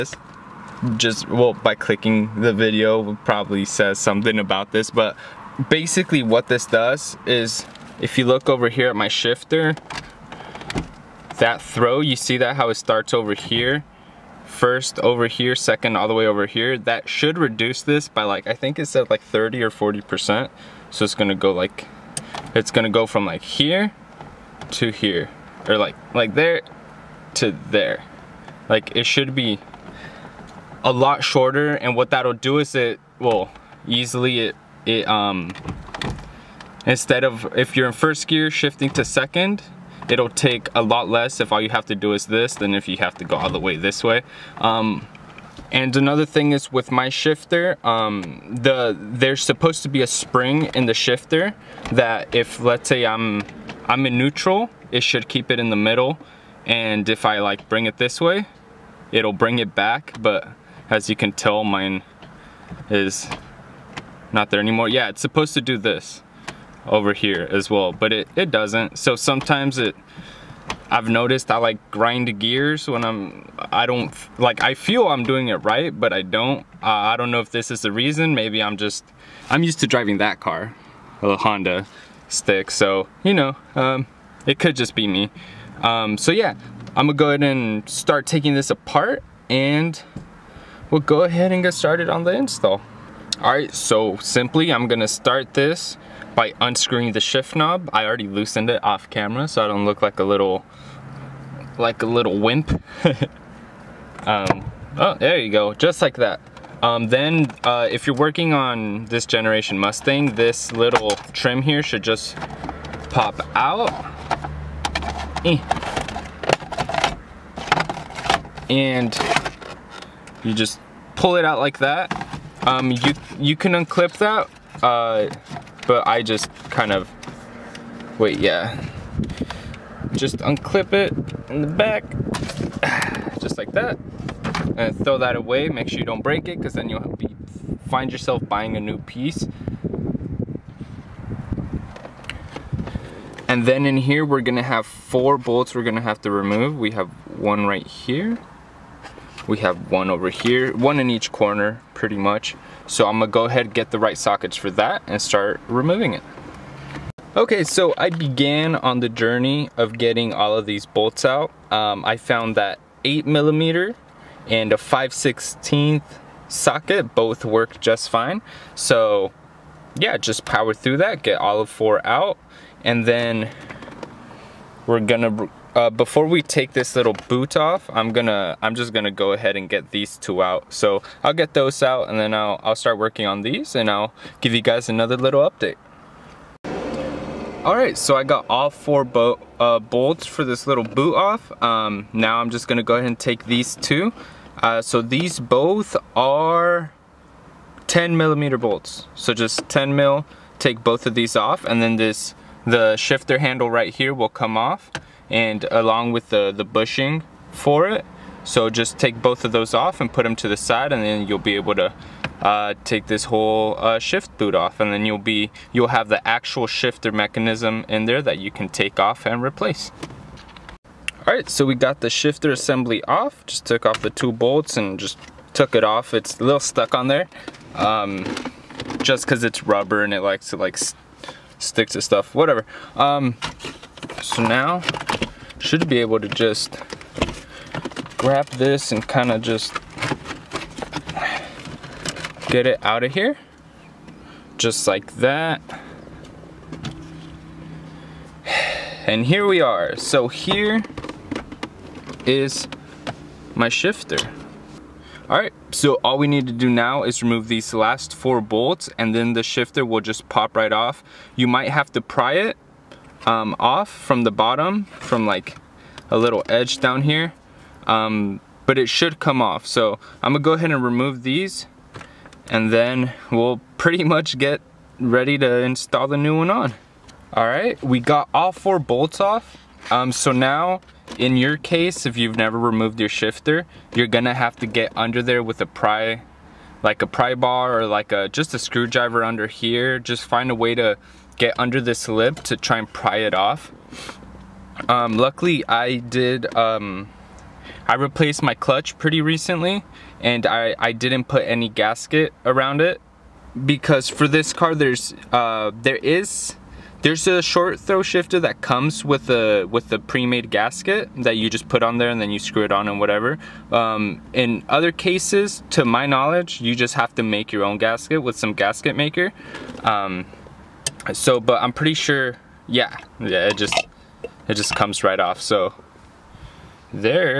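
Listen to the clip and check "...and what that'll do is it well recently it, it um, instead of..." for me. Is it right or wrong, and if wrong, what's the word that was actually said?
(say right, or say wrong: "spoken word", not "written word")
wrong: "easily", not "recently".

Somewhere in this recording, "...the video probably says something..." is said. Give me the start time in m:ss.
0:02.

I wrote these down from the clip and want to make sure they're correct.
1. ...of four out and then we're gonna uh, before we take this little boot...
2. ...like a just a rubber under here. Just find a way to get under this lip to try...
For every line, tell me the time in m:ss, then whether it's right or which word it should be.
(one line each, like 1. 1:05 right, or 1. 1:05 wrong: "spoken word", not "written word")
1. 2:51 right
2. 4:47 wrong: "screwdriver", not "rubber".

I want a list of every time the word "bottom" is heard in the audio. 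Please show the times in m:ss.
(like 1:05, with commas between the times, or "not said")
4:24.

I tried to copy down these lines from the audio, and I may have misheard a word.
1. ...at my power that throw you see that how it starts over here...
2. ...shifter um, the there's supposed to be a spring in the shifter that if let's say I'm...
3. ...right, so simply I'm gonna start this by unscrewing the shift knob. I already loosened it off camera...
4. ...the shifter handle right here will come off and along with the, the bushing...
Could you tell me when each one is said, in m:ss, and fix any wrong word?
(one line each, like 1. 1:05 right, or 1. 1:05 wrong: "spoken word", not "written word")
1. 0:08 wrong: "shifter", not "power"
2. 0:47 right
3. 1:33 right
4. 3:22 right.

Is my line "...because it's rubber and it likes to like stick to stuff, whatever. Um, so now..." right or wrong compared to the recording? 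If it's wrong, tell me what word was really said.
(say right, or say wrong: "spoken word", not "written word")
right.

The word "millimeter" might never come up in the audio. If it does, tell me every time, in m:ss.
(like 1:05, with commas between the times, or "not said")
2:43, 3:18.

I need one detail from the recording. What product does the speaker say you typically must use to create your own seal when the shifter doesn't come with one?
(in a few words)
gasket maker.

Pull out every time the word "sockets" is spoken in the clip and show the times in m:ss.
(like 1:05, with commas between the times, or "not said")
2:34, 2:46.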